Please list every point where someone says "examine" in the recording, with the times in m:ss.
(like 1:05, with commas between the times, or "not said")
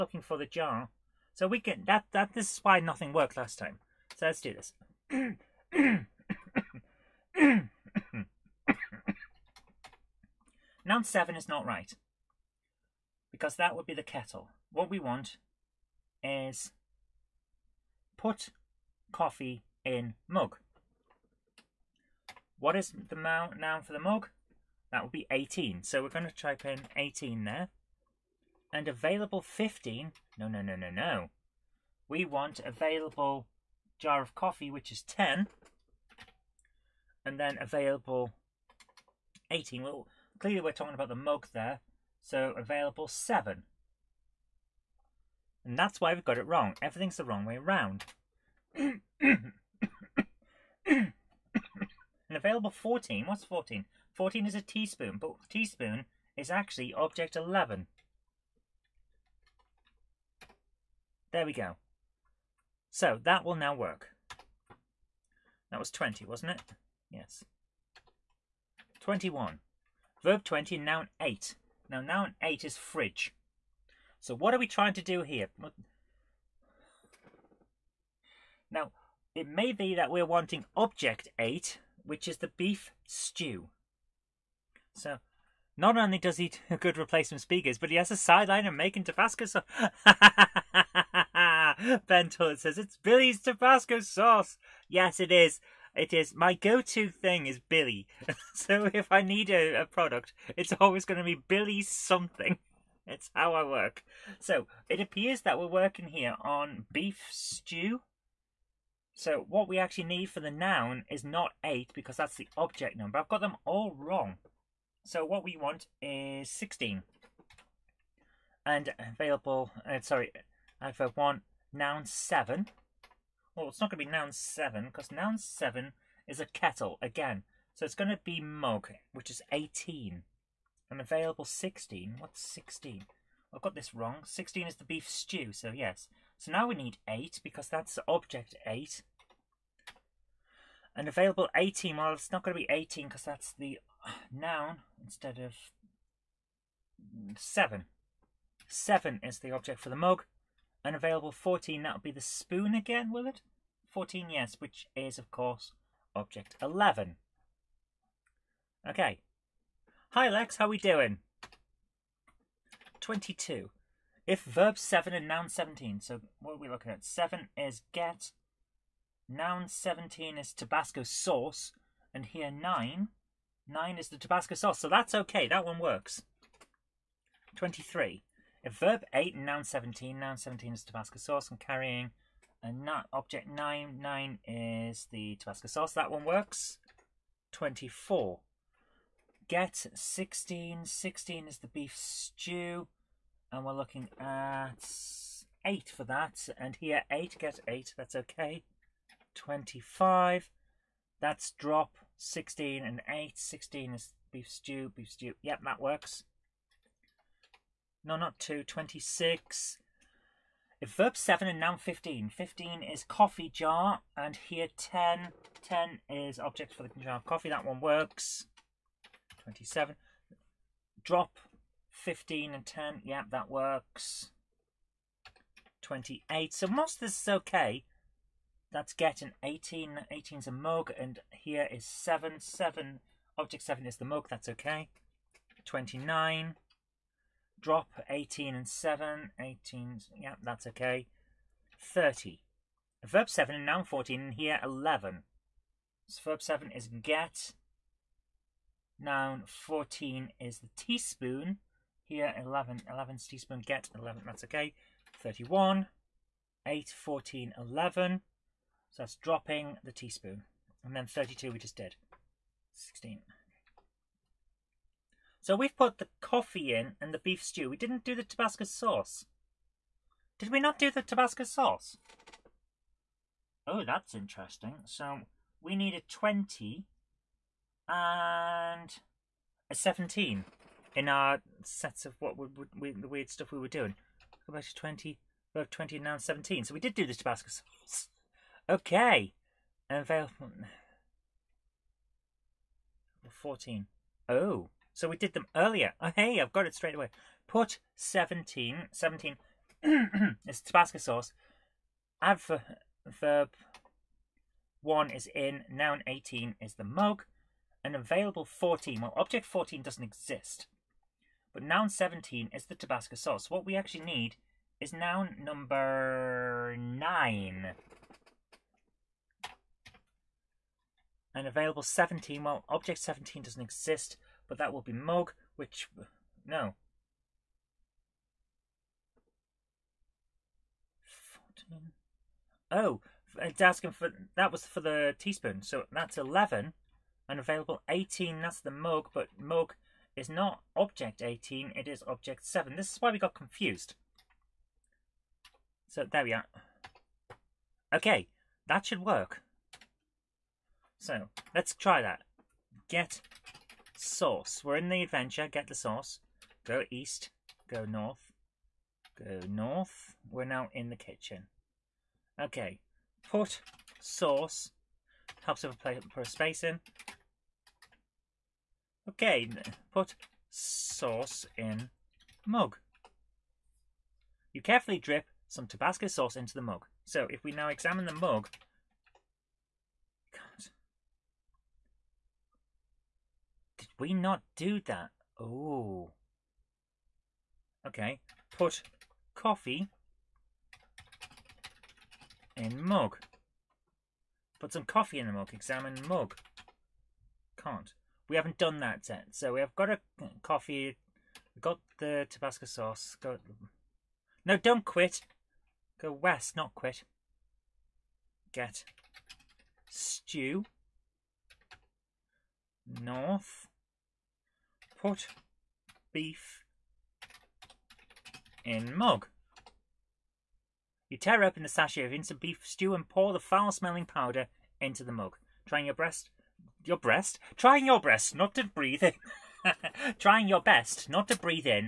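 6:17, 6:35.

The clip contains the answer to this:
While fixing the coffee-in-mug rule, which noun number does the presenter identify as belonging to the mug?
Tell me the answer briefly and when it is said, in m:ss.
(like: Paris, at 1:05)
18, at 0:24.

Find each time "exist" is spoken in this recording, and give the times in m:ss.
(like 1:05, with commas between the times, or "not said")
5:10, 5:23.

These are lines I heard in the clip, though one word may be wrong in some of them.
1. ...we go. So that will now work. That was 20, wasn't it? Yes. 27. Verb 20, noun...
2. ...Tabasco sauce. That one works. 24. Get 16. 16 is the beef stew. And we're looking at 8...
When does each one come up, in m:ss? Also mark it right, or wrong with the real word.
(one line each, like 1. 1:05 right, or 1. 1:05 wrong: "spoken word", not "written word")
1. 1:01 wrong: "21", not "27"
2. 3:05 right.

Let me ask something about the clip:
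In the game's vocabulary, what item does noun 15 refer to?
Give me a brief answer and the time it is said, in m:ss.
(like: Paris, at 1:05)
Coffee jar, at 3:32.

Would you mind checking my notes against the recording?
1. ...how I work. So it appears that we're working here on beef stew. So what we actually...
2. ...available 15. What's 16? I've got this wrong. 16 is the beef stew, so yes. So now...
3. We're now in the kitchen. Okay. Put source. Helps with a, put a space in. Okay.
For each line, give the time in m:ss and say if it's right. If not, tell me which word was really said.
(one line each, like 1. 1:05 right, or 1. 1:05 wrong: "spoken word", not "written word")
1. 1:43 right
2. 2:11 wrong: "16", not "15"
3. 6:00 right.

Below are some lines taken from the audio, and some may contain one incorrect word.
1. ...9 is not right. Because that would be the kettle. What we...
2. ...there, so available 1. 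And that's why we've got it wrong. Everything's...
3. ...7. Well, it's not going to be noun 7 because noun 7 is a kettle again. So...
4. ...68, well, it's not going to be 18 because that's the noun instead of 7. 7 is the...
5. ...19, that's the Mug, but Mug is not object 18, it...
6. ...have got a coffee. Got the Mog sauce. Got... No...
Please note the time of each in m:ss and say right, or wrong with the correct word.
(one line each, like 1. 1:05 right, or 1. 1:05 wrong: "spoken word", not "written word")
1. 0:11 wrong: "7", not "9"
2. 0:41 wrong: "7", not "1"
3. 2:02 right
4. 2:21 wrong: "18", not "68"
5. 5:37 wrong: "18", not "19"
6. 6:39 wrong: "Tabasco", not "Mog".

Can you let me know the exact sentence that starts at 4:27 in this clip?
We didn't do the Tabasco sauce.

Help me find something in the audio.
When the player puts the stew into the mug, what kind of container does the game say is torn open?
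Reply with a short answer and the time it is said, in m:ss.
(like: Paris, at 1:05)
Sachet, at 7:01.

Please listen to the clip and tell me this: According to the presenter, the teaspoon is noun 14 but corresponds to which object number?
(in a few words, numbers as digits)
11.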